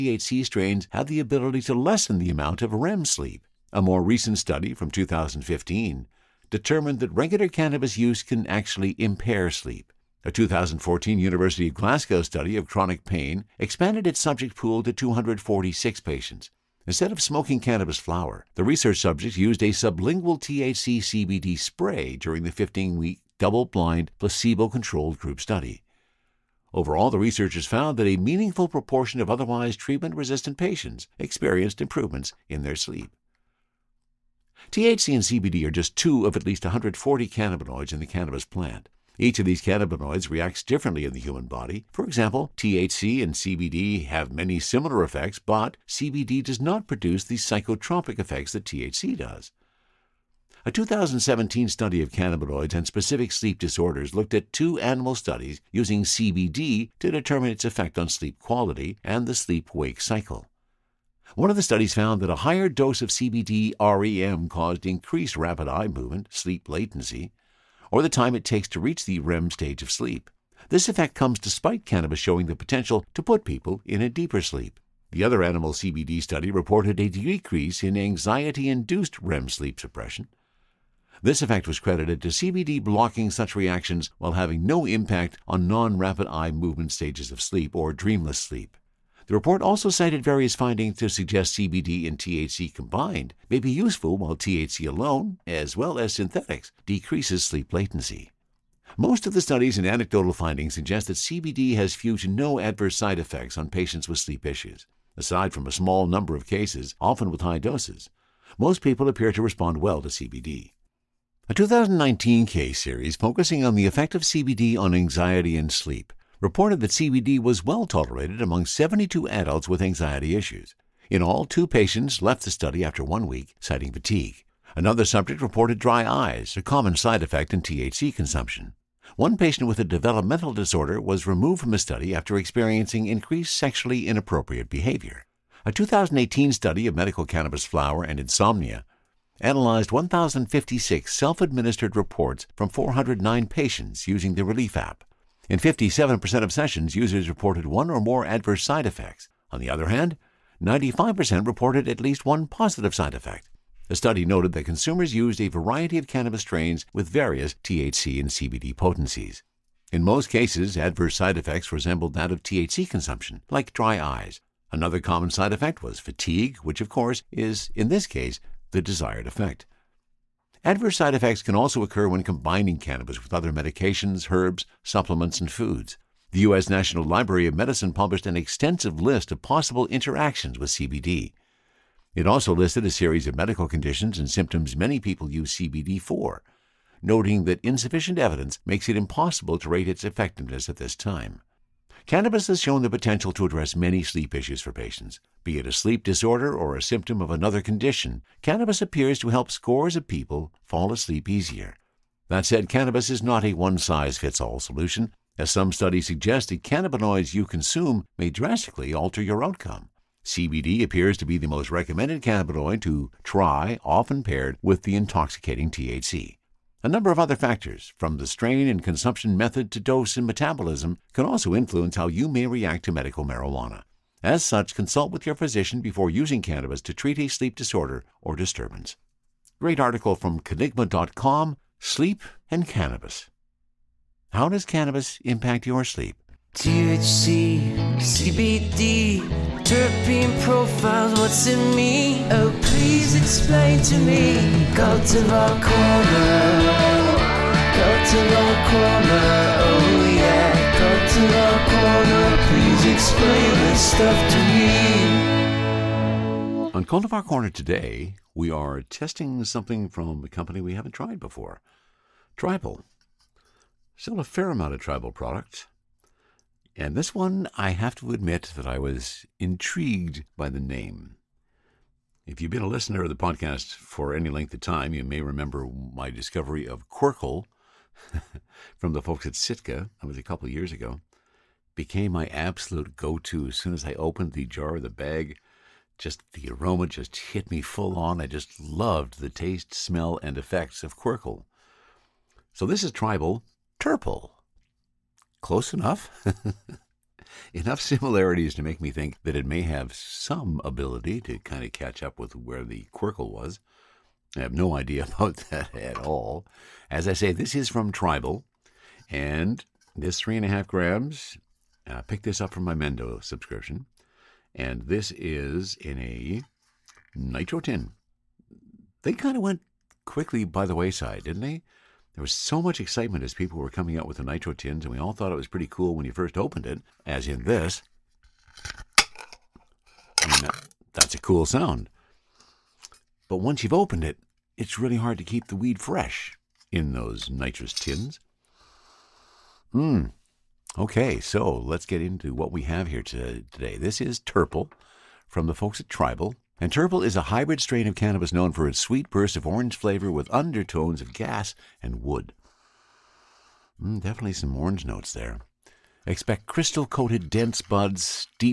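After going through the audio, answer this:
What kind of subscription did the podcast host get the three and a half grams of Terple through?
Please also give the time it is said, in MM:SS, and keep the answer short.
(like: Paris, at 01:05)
Mendo subscription, at 05:12.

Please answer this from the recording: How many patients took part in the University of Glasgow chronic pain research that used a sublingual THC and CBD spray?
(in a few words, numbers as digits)
246.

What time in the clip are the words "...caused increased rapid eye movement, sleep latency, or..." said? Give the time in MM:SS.
01:04.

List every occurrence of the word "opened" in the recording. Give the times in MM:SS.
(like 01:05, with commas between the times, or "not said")
04:43, 05:26, 05:33.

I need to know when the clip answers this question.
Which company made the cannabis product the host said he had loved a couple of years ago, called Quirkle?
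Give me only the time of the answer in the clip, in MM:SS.
04:39.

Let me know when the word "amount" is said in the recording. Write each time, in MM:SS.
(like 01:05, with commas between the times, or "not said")
00:02, 04:24.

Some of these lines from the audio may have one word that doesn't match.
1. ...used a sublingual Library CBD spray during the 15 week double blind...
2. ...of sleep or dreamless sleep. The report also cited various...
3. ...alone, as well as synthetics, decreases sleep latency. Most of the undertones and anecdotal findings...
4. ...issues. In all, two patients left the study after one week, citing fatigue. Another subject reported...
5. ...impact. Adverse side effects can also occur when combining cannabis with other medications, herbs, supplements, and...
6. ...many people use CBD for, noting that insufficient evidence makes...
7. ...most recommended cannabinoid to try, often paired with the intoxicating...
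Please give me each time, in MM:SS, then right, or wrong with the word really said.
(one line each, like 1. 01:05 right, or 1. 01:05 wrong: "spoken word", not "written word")
1. 00:19 wrong: "THC", not "Library"
2. 01:27 right
3. 01:34 wrong: "studies", not "undertones"
4. 02:00 right
5. 02:49 wrong: "effect", not "impact"
6. 03:04 right
7. 03:31 right.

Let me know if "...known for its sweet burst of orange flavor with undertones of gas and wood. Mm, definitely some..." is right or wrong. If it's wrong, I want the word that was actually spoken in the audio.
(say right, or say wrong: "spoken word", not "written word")
right.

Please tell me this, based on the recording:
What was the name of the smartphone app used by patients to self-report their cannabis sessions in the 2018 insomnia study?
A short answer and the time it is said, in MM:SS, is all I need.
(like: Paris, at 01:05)
Relief, at 02:24.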